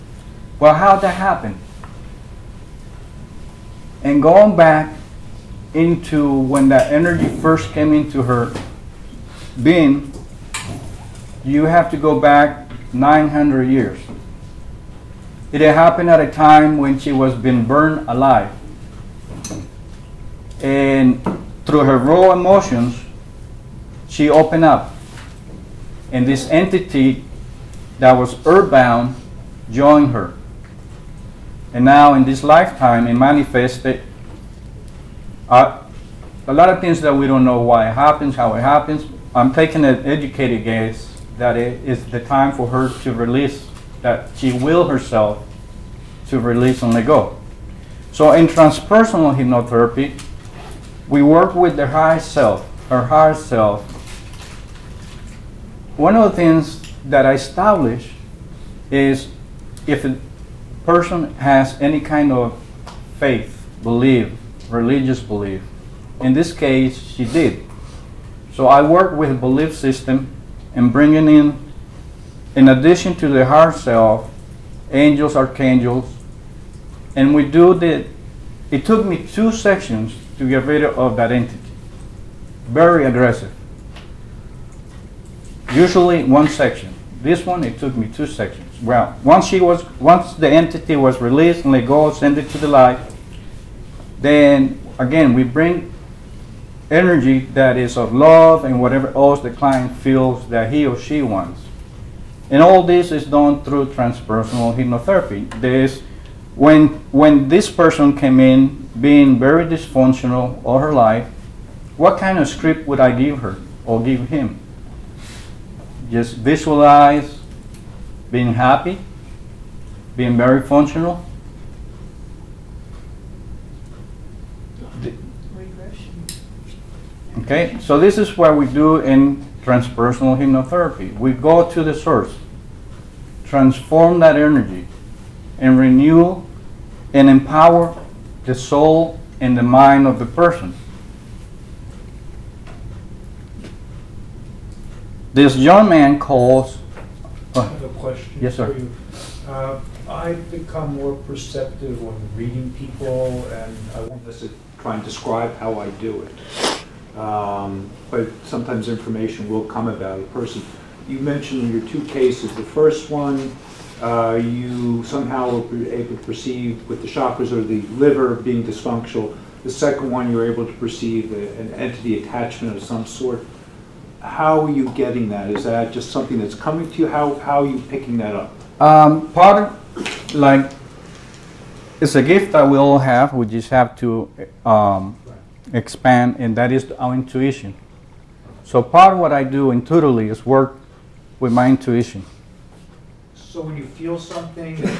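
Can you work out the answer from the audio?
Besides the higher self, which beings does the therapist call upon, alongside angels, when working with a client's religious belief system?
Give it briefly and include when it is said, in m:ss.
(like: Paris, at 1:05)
Archangels, at 1:15.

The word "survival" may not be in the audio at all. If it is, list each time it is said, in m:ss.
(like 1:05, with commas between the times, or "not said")
not said.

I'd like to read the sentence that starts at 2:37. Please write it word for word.
Um, but sometimes information will come about a person.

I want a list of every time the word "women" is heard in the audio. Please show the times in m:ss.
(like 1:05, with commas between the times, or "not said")
not said.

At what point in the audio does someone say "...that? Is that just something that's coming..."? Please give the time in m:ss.
2:55.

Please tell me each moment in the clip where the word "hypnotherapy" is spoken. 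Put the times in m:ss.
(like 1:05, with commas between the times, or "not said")
0:49, 1:44, 2:10.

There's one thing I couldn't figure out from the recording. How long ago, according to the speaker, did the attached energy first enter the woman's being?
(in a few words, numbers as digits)
900 years.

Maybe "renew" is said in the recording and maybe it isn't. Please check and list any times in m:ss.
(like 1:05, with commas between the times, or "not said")
2:15.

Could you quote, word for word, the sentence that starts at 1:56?
Just visualize being happy, being very functional.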